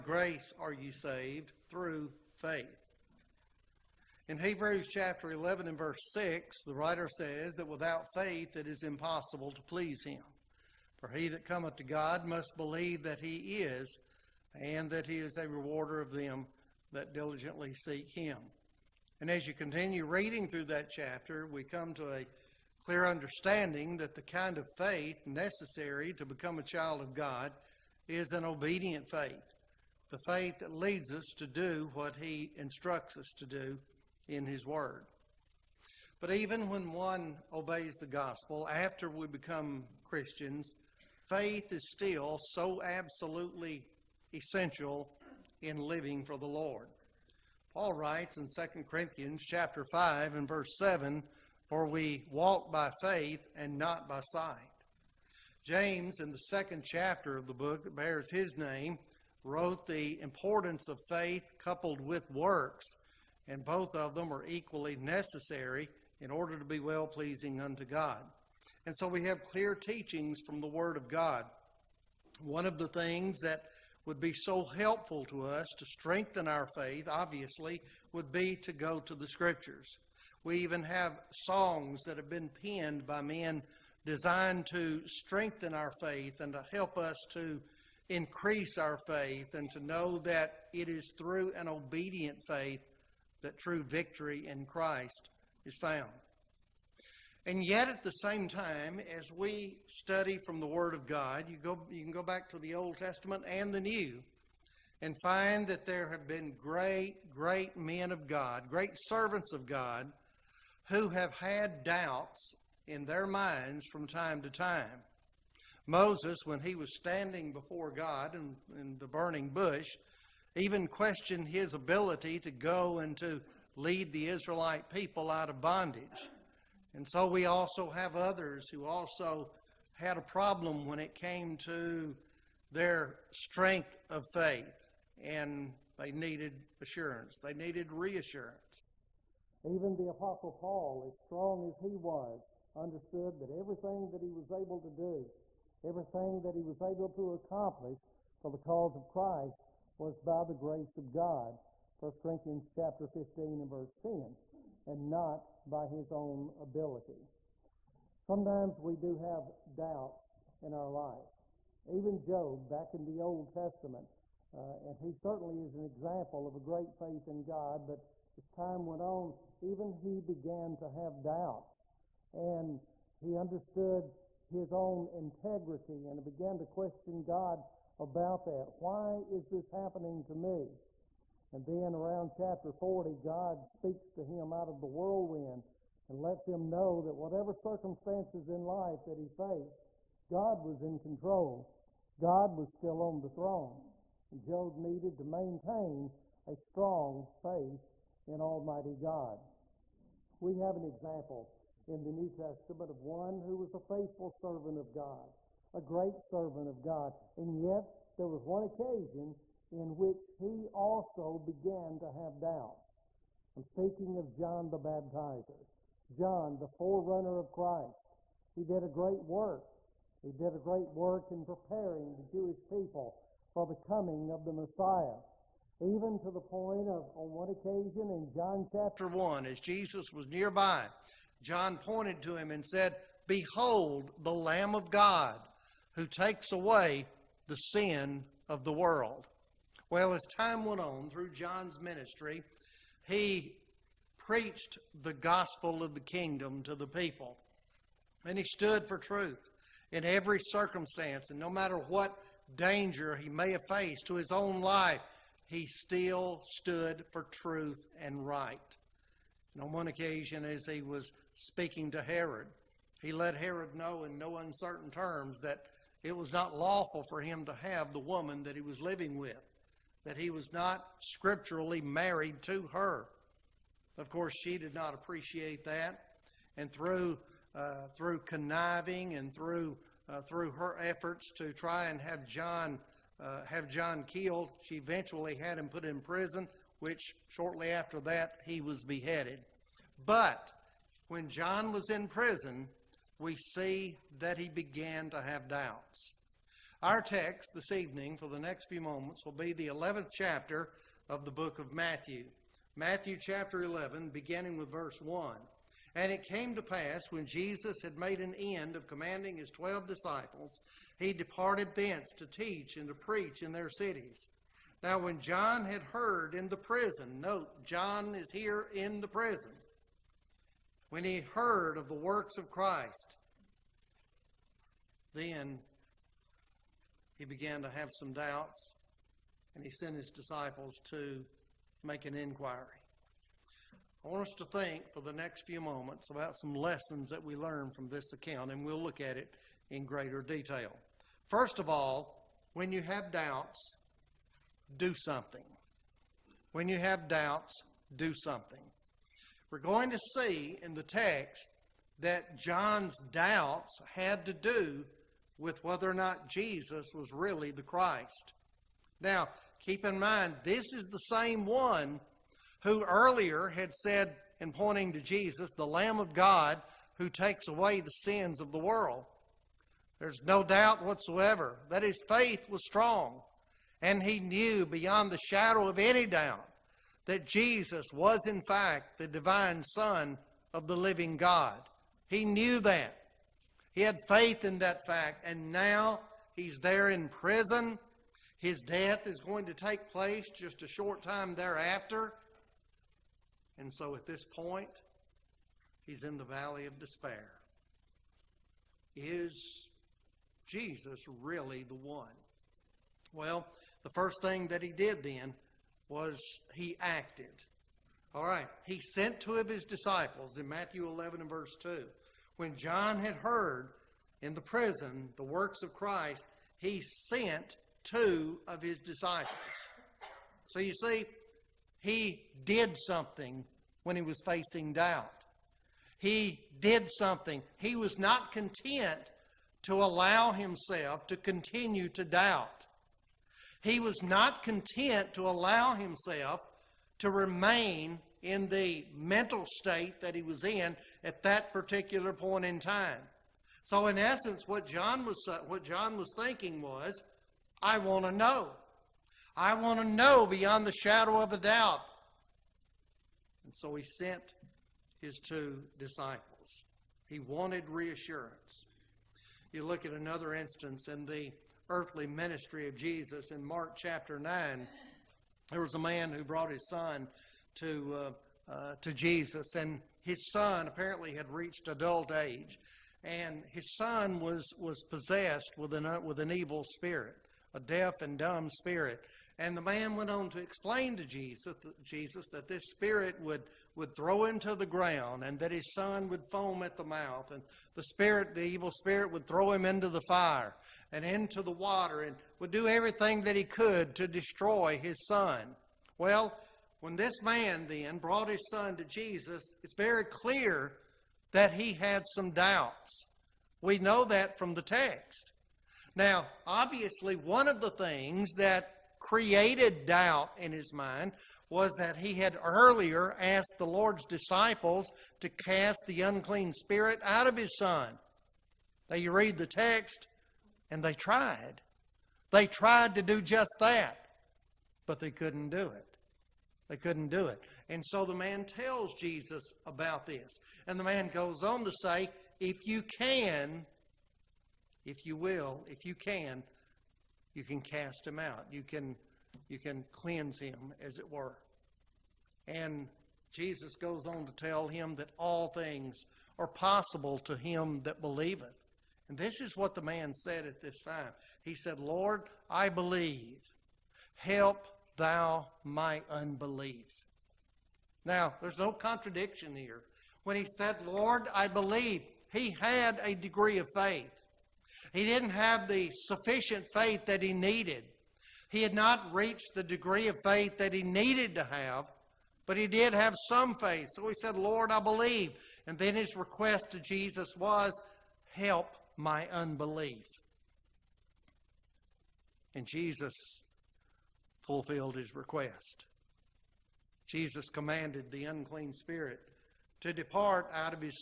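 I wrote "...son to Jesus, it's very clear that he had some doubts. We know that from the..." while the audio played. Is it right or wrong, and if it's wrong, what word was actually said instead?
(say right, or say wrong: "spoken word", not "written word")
right.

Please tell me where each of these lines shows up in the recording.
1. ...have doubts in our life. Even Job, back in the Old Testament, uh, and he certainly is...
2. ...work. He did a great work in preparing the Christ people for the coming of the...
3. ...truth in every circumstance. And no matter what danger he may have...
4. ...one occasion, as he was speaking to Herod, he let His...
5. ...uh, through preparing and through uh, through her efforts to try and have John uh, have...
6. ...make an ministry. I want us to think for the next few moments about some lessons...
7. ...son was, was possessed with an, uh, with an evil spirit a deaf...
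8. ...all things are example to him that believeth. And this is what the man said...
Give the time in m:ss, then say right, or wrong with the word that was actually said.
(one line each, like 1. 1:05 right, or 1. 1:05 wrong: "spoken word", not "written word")
1. 2:39 right
2. 3:39 wrong: "Jewish", not "Christ"
3. 4:08 right
4. 4:19 wrong: "Herod", not "His"
5. 4:37 wrong: "conniving", not "preparing"
6. 5:31 wrong: "inquiry", not "ministry"
7. 7:53 right
8. 9:05 wrong: "possible", not "example".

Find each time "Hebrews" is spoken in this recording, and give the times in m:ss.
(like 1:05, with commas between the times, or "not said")
0:04.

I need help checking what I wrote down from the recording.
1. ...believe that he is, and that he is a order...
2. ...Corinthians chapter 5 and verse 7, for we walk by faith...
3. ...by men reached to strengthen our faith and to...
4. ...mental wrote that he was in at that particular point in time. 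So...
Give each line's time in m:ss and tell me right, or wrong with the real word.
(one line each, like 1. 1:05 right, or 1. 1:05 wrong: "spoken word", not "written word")
1. 0:12 wrong: "rewarder", not "order"
2. 0:48 right
3. 1:23 wrong: "designed", not "reached"
4. 7:18 wrong: "state", not "wrote".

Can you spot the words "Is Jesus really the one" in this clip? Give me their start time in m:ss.
6:38.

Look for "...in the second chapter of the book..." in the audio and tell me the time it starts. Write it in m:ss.
0:56.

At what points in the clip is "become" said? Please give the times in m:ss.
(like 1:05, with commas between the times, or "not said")
0:26, 0:39.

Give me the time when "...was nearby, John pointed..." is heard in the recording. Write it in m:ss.
3:50.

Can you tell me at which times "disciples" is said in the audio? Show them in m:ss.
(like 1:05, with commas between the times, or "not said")
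5:09, 5:30, 6:49, 6:58, 7:35, 8:34.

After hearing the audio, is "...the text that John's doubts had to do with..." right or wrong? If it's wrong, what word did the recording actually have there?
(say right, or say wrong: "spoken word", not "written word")
right.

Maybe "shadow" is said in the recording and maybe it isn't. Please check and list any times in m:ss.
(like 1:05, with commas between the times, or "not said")
6:15, 7:30.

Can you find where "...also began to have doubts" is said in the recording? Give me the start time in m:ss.
3:30.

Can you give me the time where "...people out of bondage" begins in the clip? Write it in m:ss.
2:04.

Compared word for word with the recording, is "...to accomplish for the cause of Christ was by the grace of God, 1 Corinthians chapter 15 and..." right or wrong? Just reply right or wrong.
right.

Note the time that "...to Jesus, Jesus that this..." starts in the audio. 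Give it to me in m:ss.
8:00.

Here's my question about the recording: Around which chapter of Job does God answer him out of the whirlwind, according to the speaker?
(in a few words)
40.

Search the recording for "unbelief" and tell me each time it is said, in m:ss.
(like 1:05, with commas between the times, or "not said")
9:16, 9:39.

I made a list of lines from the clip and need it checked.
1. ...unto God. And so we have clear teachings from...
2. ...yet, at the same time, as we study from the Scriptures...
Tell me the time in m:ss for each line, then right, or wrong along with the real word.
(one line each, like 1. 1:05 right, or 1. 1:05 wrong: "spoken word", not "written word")
1. 1:07 right
2. 1:37 wrong: "Word", not "Scriptures".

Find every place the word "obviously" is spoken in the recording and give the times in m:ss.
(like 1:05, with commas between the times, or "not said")
1:17, 8:26.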